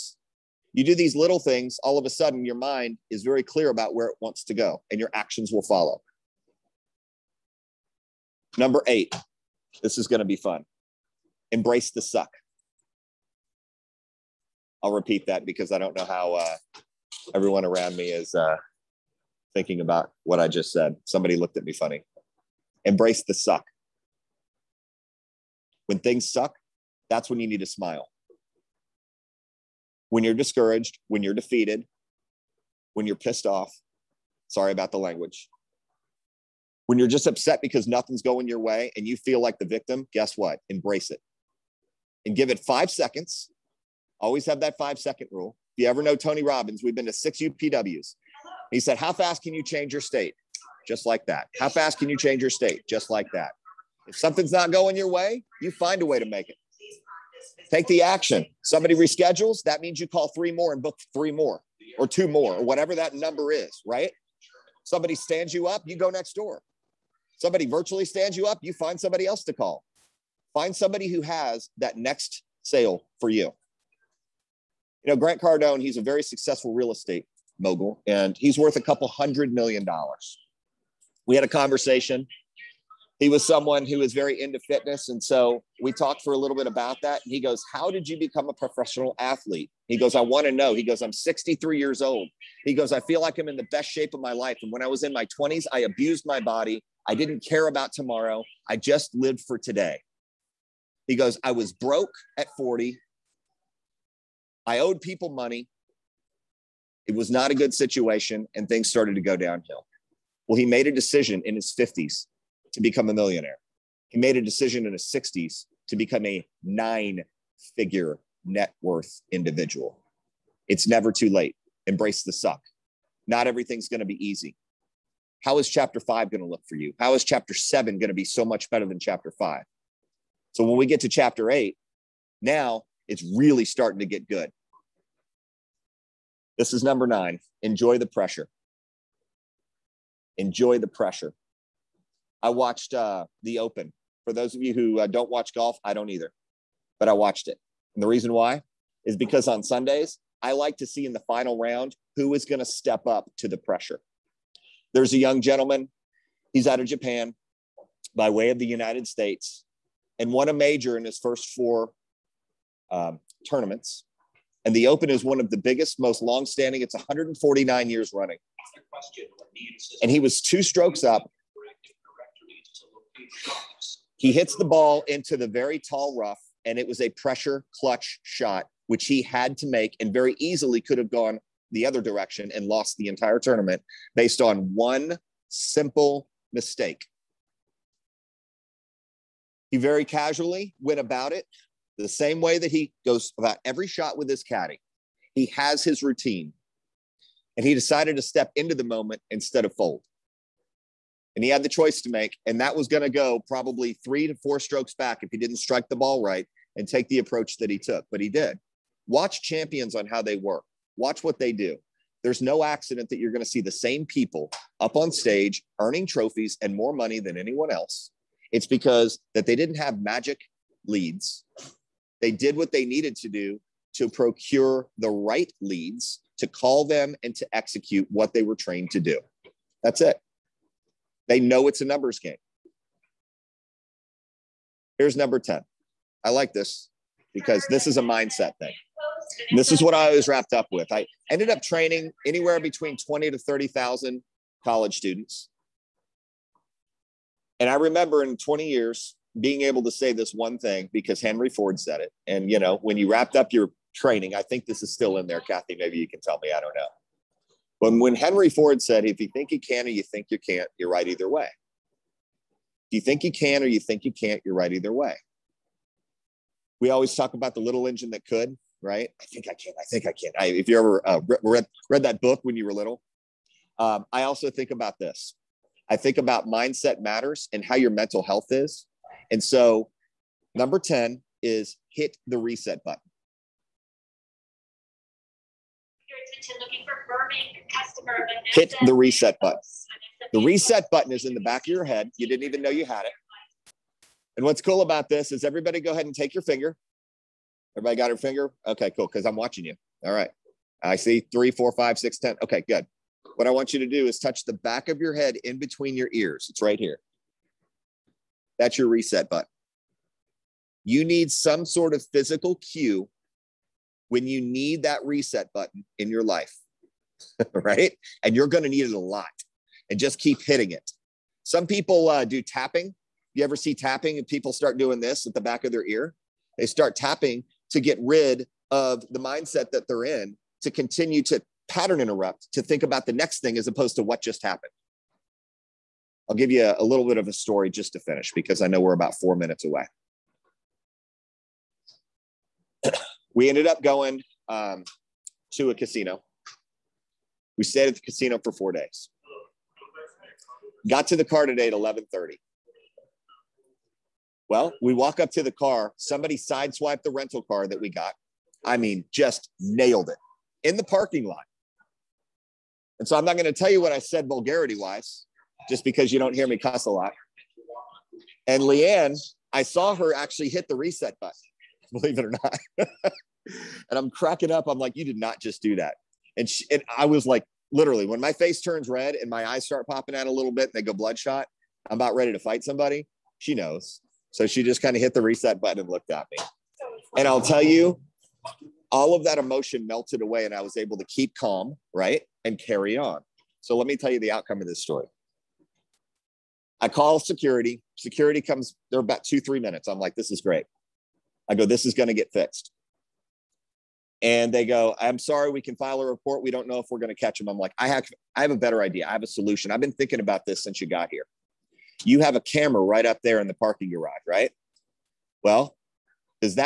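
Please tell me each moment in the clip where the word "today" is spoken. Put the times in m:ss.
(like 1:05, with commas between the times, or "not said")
1:39, 5:51.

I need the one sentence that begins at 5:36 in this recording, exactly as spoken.
I'll give you a, a little bit of a story just to finish because I know we're about four minutes away.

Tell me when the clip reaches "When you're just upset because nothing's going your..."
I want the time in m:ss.
0:36.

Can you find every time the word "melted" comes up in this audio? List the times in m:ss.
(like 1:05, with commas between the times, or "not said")
6:29.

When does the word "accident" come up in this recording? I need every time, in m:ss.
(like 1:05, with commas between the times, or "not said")
3:32.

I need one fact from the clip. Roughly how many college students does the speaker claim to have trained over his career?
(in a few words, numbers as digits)
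20,000 to 30,000.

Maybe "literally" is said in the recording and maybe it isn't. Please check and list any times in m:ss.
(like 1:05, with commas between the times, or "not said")
6:17.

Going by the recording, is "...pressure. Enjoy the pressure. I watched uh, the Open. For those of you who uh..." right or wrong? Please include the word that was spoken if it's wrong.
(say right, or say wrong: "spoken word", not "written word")
right.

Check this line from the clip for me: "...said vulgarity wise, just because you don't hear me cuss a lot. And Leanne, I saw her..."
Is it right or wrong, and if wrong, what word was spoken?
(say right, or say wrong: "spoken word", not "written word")
right.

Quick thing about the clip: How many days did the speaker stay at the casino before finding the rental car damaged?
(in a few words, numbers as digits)
4.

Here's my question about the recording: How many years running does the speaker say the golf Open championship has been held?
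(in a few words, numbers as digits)
149.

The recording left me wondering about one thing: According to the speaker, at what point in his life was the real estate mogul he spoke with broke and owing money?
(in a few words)
At 40.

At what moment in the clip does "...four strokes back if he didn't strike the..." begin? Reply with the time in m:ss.
3:24.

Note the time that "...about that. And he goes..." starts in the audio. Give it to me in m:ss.
1:26.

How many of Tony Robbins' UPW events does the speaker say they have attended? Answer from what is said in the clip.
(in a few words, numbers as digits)
6.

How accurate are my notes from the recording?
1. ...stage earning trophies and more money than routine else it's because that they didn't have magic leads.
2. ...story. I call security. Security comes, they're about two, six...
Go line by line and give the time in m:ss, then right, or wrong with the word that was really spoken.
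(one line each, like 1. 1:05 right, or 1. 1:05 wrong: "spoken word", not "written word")
1. 3:35 wrong: "anyone", not "routine"
2. 6:34 wrong: "three", not "six".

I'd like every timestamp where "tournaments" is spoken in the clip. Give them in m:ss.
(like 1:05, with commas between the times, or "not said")
2:43, 3:03.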